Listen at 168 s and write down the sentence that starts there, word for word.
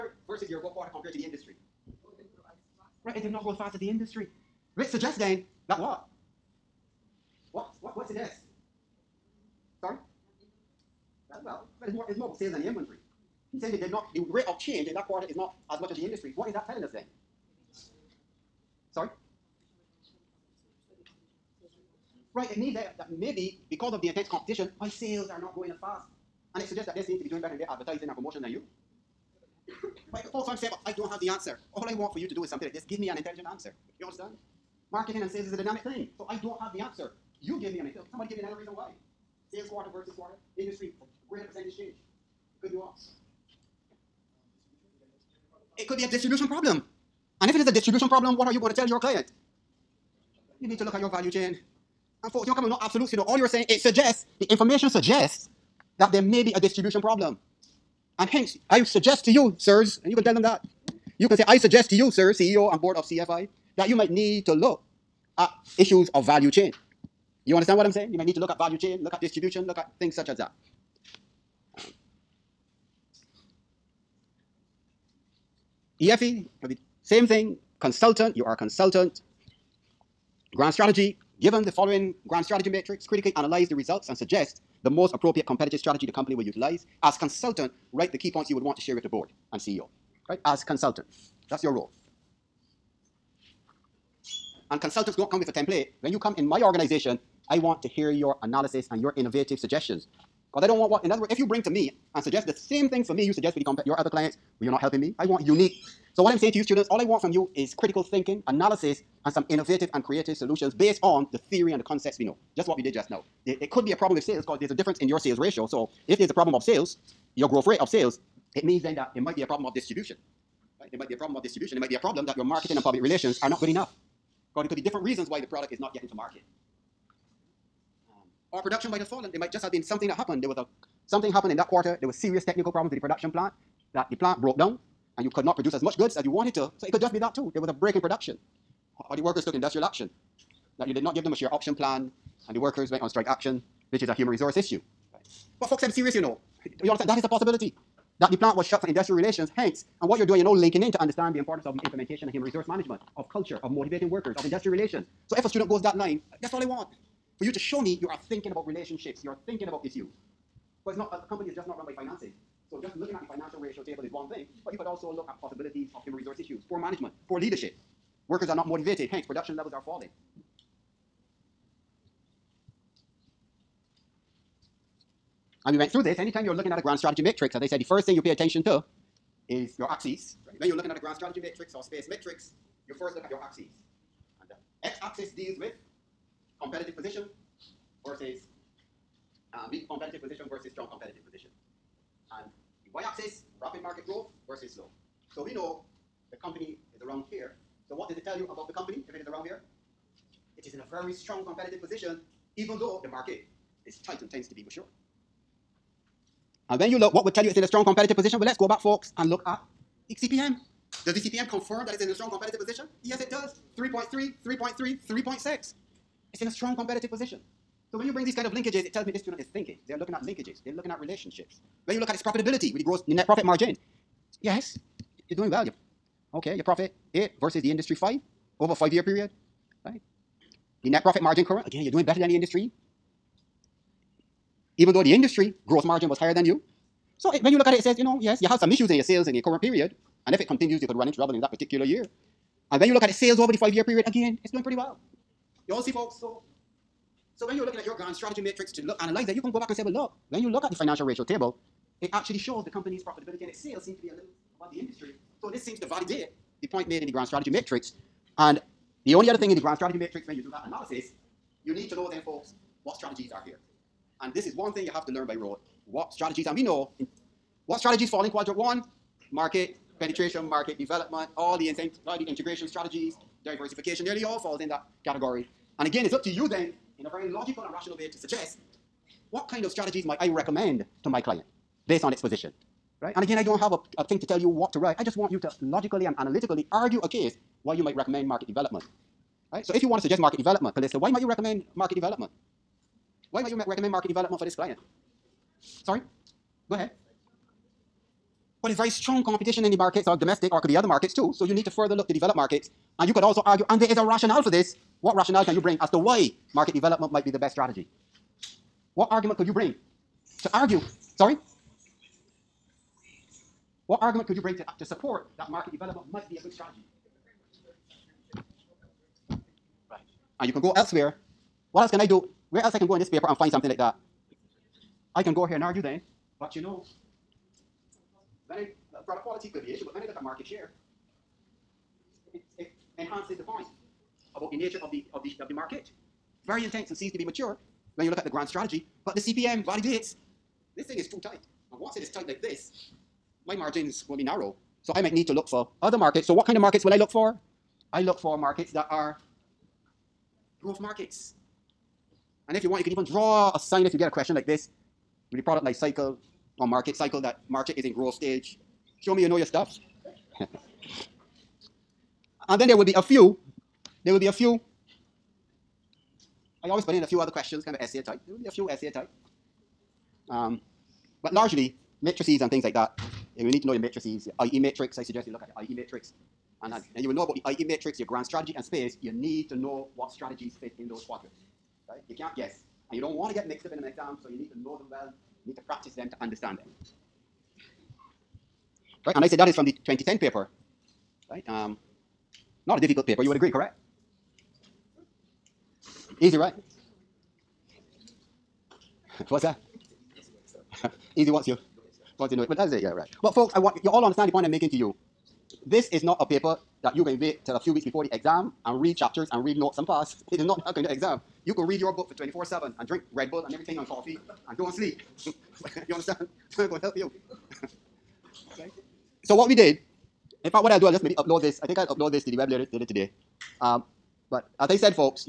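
Workers are not motivated, hence production levels are falling.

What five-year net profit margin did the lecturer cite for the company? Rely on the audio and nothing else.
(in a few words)
8.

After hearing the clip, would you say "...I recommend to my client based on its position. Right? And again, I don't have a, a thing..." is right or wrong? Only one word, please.
right.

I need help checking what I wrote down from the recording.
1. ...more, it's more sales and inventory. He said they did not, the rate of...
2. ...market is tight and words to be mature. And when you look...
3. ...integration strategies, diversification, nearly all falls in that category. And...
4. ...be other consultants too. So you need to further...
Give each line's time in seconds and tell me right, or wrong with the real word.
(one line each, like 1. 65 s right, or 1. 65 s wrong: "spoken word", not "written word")
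1. 11 s right
2. 203 s wrong: "tends", not "words"
3. 272 s right
4. 300 s wrong: "markets", not "consultants".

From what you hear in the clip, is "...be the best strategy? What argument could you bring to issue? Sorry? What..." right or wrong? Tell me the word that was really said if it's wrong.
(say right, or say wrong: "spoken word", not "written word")
wrong: "argue", not "issue".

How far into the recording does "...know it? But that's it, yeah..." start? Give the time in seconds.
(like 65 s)
402 s.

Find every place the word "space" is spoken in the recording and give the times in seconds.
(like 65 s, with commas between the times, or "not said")
181 s, 378 s.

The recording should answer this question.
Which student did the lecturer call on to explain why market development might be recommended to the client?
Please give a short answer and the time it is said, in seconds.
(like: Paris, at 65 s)
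Callista, at 290 s.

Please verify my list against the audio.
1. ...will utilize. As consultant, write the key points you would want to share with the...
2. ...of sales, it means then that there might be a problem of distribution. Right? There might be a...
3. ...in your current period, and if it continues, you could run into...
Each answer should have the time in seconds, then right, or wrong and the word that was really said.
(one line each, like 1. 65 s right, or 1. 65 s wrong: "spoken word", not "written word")
1. 86 s right
2. 117 s right
3. 239 s right.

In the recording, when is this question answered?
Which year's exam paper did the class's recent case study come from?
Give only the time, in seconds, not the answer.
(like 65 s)
389 s.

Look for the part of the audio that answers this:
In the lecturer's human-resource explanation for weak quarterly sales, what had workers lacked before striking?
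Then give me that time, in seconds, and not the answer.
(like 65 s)
141 s.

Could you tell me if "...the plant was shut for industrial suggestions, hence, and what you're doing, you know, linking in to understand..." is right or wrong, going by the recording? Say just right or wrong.
wrong.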